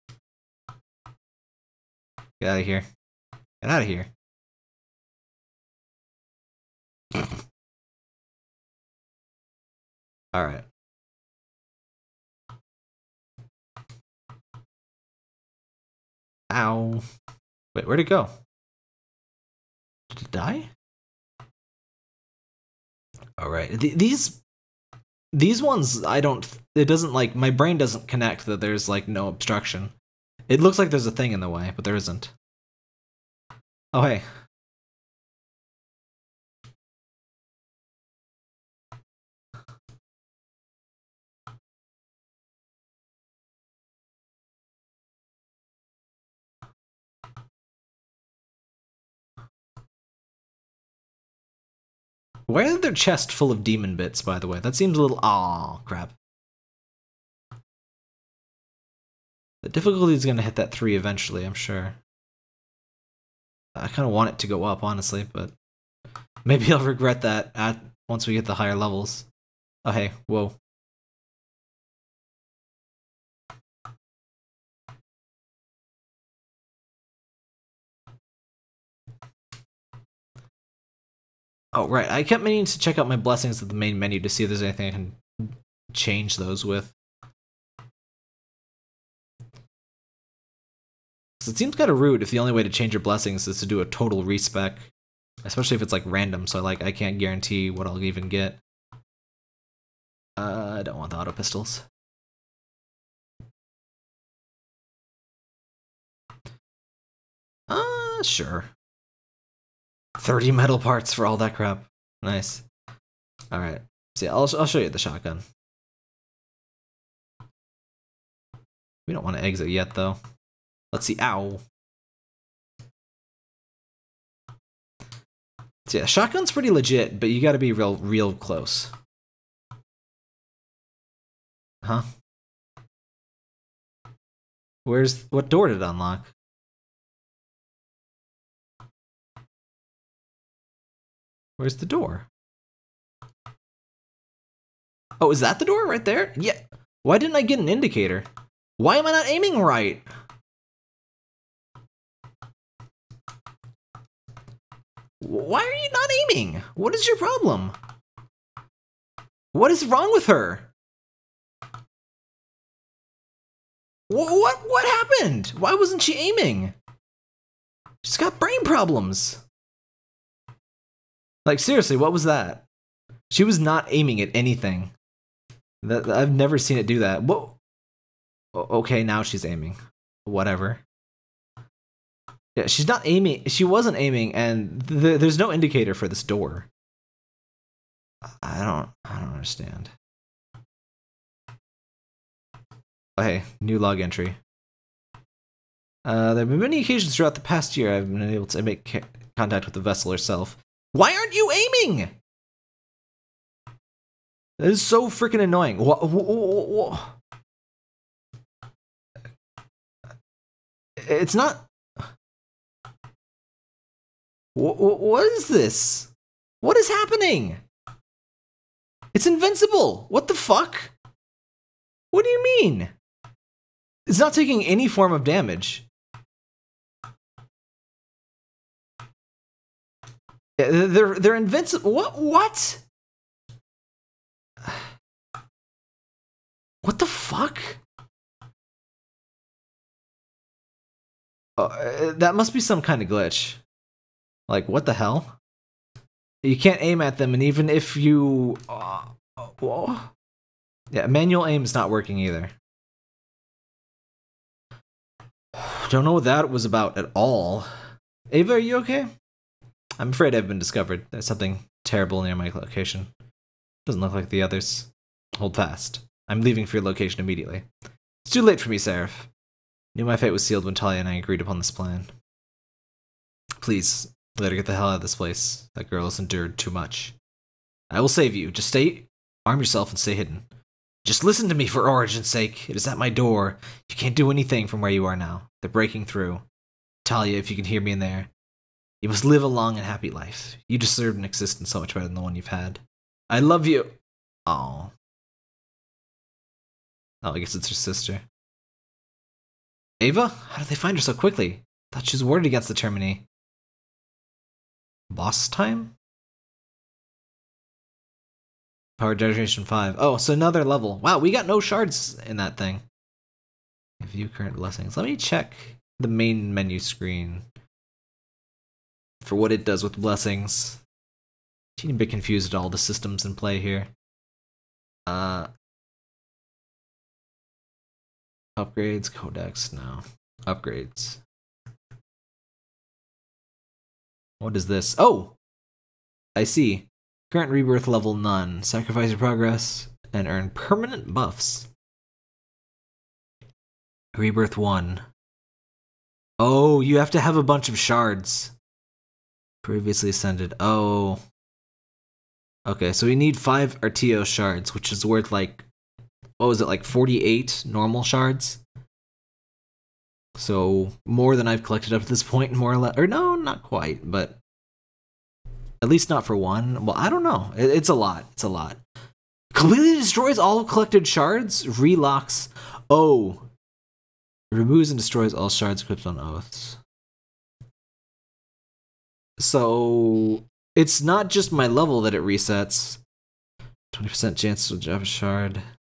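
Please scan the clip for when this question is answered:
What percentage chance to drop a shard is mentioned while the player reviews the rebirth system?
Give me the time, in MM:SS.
06:23.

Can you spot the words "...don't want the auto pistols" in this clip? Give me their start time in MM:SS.
01:40.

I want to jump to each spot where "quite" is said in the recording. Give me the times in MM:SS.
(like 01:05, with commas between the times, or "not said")
06:03.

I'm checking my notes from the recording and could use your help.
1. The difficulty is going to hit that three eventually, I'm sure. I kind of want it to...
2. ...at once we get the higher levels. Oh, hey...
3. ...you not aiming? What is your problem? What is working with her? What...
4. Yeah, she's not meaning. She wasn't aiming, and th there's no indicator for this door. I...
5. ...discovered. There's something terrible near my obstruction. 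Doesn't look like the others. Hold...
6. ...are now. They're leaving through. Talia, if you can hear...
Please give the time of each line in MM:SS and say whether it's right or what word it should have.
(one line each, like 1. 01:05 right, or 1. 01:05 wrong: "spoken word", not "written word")
1. 00:59 right
2. 01:07 right
3. 02:35 wrong: "wrong", not "working"
4. 03:02 wrong: "aiming", not "meaning"
5. 04:20 wrong: "location", not "obstruction"
6. 04:45 wrong: "breaking", not "leaving".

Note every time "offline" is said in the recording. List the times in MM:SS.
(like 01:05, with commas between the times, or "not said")
not said.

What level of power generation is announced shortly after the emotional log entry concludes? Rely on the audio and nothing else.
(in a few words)
5.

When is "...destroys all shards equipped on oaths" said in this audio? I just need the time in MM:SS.
06:14.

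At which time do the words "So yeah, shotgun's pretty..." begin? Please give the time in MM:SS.
02:05.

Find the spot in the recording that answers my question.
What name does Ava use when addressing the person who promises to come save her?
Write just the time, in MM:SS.
04:28.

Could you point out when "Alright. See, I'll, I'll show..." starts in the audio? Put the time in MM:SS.
01:53.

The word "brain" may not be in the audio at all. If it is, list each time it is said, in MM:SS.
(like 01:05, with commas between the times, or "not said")
00:27, 02:48.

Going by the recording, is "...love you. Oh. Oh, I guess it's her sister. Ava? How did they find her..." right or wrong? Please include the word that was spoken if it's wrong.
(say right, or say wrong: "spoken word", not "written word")
right.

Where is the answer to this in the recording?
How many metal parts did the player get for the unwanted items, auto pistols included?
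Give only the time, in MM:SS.
01:50.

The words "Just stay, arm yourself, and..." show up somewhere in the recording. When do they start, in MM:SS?
04:38.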